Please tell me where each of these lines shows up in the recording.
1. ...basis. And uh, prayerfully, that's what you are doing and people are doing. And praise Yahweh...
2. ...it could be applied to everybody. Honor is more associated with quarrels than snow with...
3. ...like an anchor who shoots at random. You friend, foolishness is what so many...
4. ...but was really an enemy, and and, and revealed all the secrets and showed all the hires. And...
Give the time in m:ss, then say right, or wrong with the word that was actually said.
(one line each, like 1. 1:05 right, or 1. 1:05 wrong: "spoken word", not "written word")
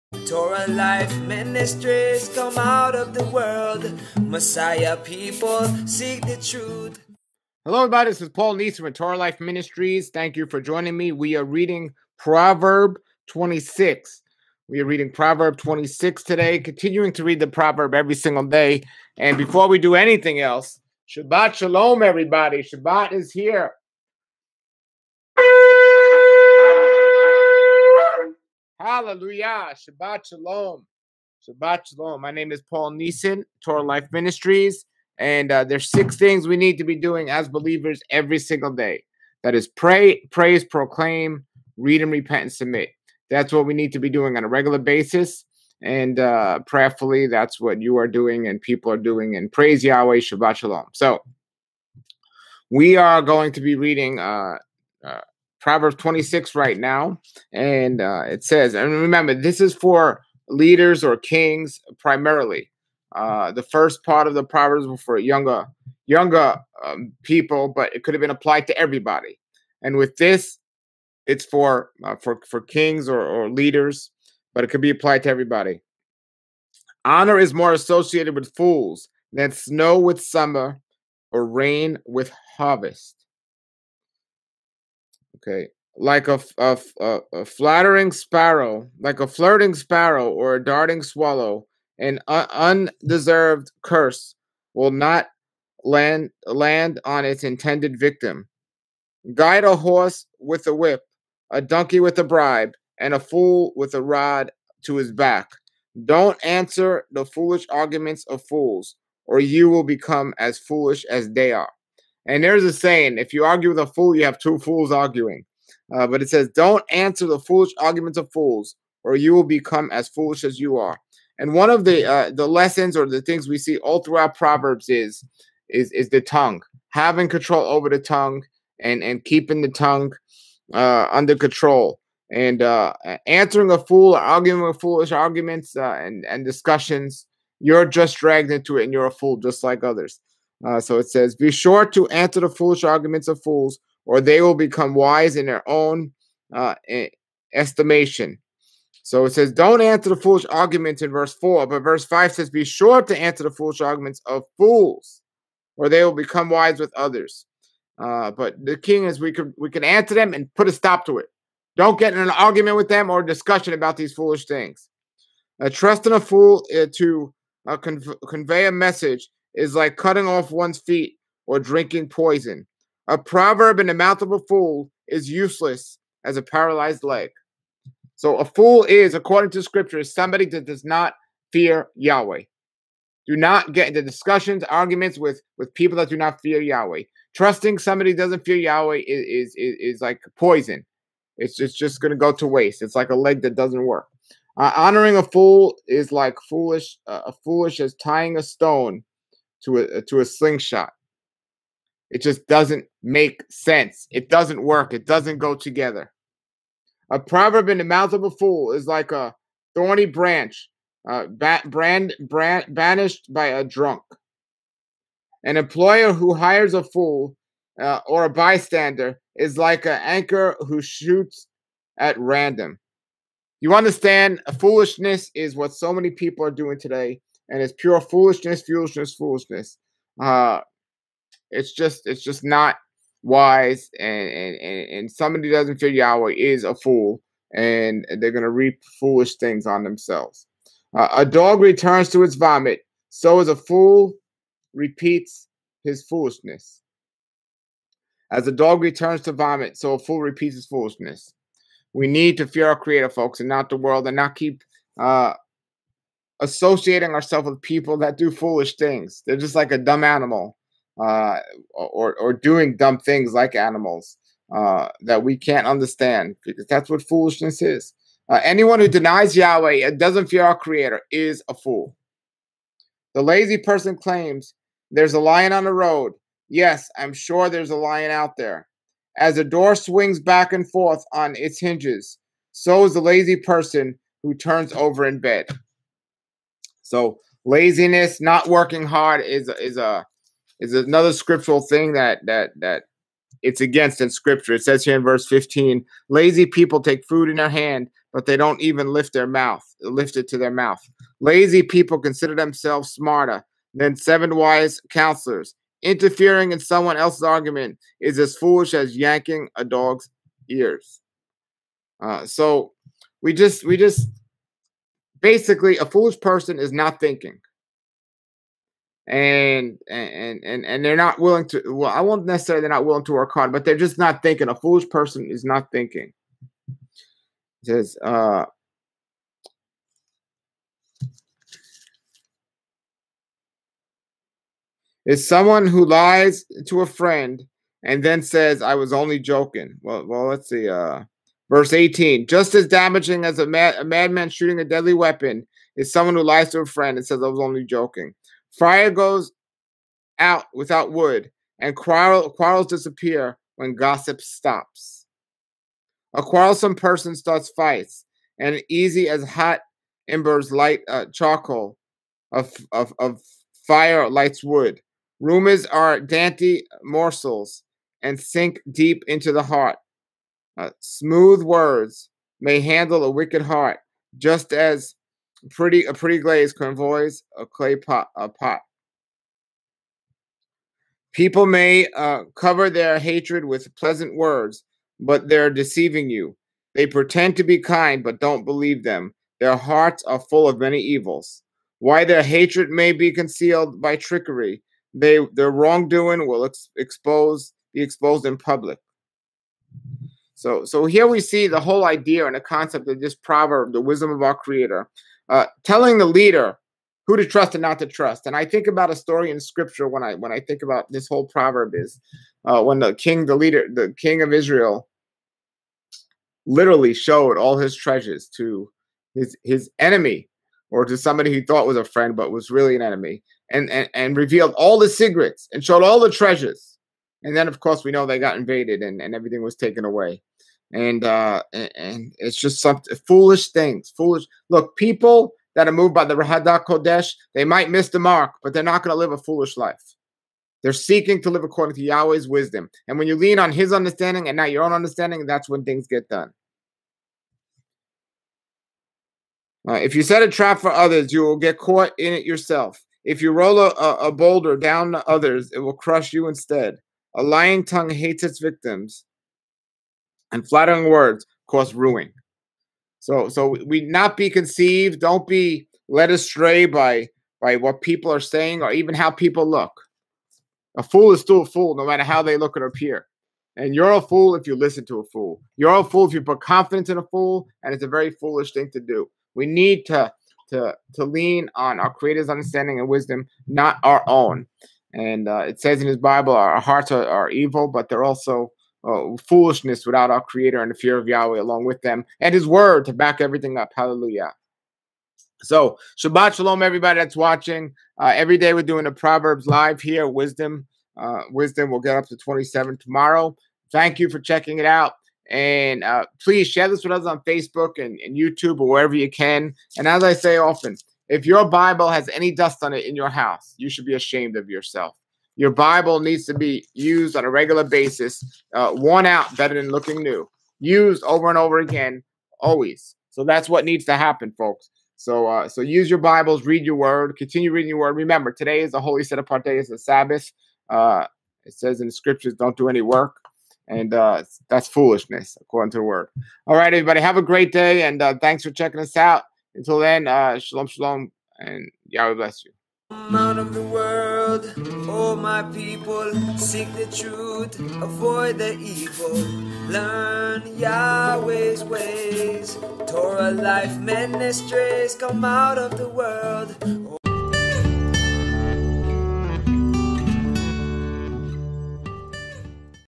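1. 0:44 right
2. 1:14 wrong: "fools", not "quarrels"
3. 3:39 wrong: "understand", not "friend"
4. 7:02 wrong: "treasures", not "hires".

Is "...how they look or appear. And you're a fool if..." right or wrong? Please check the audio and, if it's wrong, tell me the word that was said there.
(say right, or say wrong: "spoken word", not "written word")
right.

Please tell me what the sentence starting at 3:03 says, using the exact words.
Do not get into discussions, arguments with with people that do not fear Yahweh.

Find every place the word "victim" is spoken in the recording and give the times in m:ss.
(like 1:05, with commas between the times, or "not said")
1:37, 7:38.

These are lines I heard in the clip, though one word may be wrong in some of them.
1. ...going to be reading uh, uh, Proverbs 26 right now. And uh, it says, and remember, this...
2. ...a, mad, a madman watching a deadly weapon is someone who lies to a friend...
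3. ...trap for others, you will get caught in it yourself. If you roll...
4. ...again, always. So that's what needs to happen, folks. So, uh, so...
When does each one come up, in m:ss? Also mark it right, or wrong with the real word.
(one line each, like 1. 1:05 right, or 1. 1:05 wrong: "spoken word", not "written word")
1. 0:53 right
2. 5:43 wrong: "shooting", not "watching"
3. 7:30 right
4. 8:41 right.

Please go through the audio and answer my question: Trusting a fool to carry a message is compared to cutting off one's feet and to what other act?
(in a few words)
Drinking poison.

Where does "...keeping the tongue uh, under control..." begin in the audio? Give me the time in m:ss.
2:09.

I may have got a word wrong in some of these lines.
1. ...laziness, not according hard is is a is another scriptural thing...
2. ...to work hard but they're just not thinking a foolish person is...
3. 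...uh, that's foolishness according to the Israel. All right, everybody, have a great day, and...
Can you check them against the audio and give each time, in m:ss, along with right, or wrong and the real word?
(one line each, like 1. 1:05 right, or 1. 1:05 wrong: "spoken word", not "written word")
1. 4:47 wrong: "working", not "according"
2. 5:23 right
3. 8:53 wrong: "Word", not "Israel".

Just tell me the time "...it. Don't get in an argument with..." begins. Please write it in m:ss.
2:41.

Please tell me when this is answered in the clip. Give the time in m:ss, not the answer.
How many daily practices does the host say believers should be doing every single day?
0:35.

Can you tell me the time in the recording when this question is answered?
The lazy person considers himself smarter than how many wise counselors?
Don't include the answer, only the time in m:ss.
5:03.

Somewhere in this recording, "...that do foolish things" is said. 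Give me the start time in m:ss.
4:17.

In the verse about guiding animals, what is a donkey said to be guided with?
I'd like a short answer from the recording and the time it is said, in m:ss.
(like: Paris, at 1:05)
A bribe, at 1:42.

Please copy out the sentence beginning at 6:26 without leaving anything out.
They pretend to be kind, but don't believe them.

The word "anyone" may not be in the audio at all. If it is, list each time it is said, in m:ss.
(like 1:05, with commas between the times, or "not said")
4:28.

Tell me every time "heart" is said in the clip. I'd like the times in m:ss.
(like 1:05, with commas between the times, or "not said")
6:09, 6:13, 6:29, 8:06.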